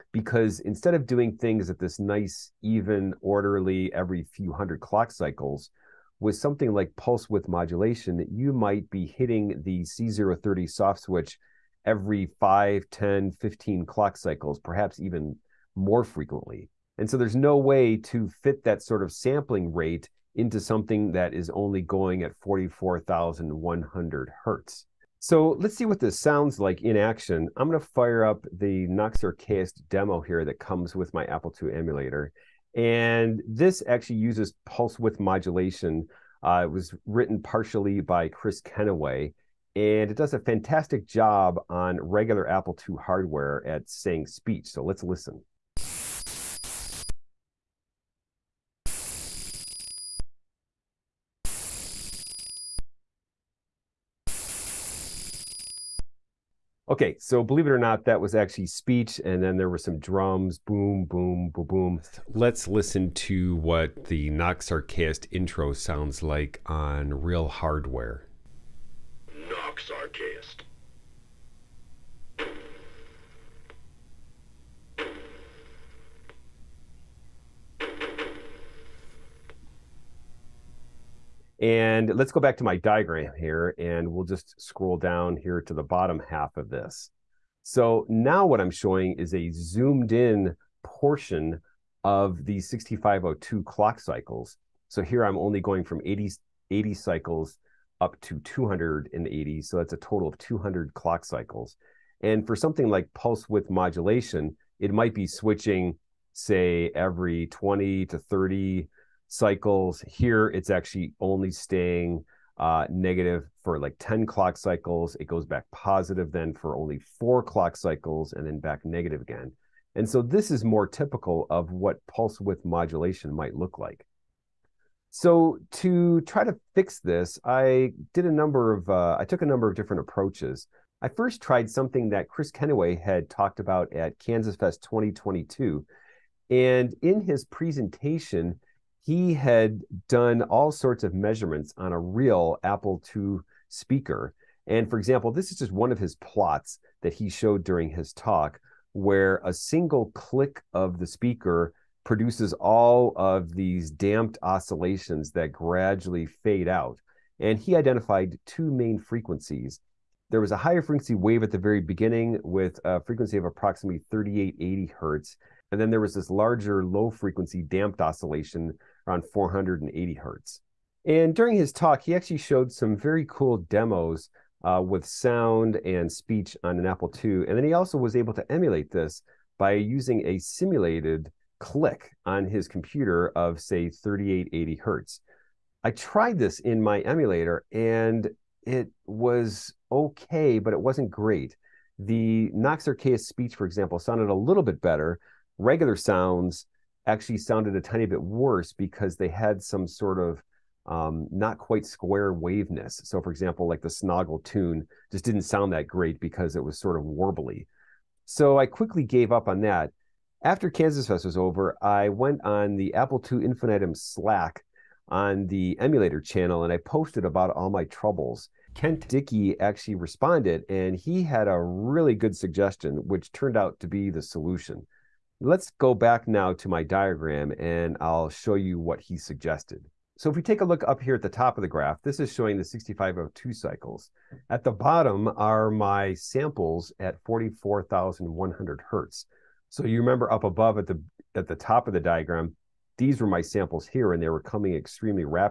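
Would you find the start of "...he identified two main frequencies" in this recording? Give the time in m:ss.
2:37.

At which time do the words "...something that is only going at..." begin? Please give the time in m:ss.
0:20.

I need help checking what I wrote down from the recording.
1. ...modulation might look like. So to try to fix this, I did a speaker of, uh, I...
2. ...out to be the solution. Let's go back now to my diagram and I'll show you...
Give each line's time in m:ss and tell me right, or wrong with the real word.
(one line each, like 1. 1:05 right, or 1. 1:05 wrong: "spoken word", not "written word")
1. 2:02 wrong: "number", not "speaker"
2. 3:43 right.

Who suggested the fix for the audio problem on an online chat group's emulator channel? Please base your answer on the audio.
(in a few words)
Kent Dickey.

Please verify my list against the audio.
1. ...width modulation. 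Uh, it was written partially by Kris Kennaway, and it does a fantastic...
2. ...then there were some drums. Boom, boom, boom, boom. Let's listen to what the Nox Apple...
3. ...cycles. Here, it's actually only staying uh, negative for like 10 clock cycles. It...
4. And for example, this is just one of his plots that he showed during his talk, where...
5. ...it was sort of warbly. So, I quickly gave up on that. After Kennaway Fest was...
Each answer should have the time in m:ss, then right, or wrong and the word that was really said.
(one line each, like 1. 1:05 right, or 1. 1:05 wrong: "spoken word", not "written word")
1. 0:34 right
2. 0:59 wrong: "Archaist", not "Apple"
3. 1:49 right
4. 2:24 right
5. 3:26 wrong: "Kansas", not "Kennaway".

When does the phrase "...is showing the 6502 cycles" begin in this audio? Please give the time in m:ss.
3:52.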